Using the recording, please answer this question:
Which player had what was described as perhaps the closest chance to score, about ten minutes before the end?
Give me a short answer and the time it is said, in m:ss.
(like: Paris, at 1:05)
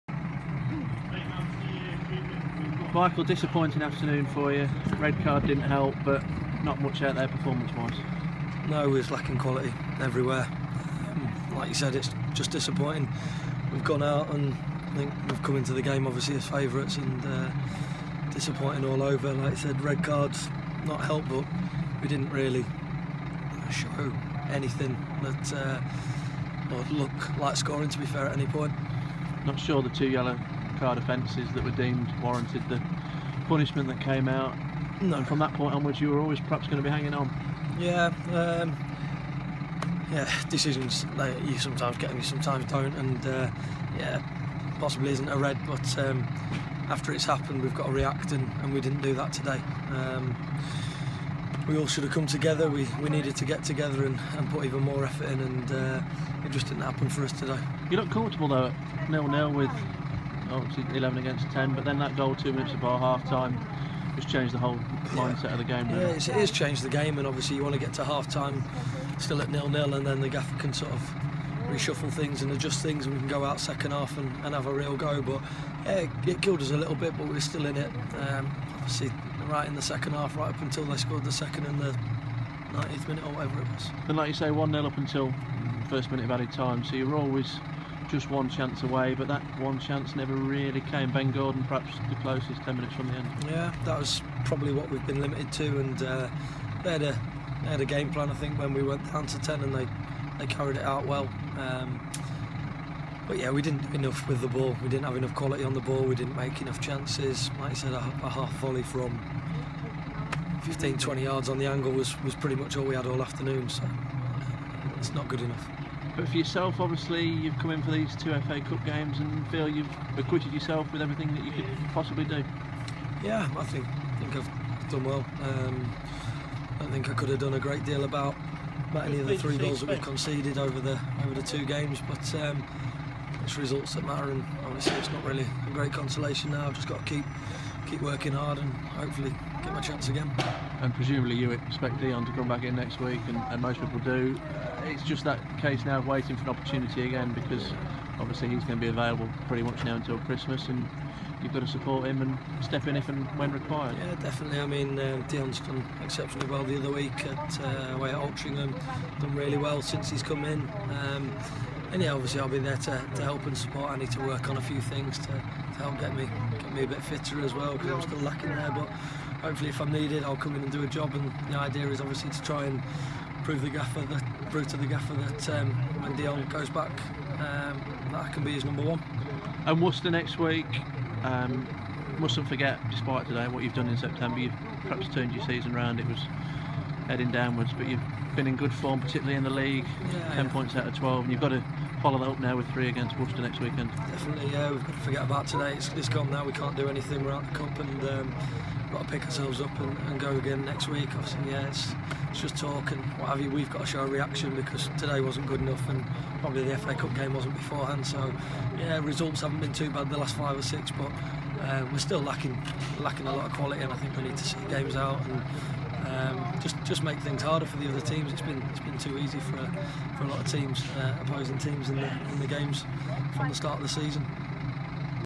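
Ben Gordon, at 1:31.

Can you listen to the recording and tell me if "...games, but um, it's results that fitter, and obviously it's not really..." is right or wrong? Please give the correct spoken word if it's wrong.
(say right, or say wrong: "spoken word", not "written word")
wrong: "matter", not "fitter".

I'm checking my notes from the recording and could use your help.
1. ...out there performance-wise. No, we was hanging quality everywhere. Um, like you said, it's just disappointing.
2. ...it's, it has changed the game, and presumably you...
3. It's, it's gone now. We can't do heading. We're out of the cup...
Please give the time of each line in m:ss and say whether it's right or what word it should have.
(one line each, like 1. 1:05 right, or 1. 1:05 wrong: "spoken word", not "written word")
1. 0:07 wrong: "lacking", not "hanging"
2. 1:06 wrong: "obviously", not "presumably"
3. 3:15 wrong: "anything", not "heading".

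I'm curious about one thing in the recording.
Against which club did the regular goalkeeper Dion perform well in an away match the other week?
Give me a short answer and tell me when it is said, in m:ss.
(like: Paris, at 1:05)
Altrincham, at 2:38.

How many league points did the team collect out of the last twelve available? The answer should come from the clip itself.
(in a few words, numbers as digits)
10.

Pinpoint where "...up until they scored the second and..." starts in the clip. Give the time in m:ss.
1:20.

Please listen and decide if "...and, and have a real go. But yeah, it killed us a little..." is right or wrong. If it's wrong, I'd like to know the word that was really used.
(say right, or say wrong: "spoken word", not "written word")
right.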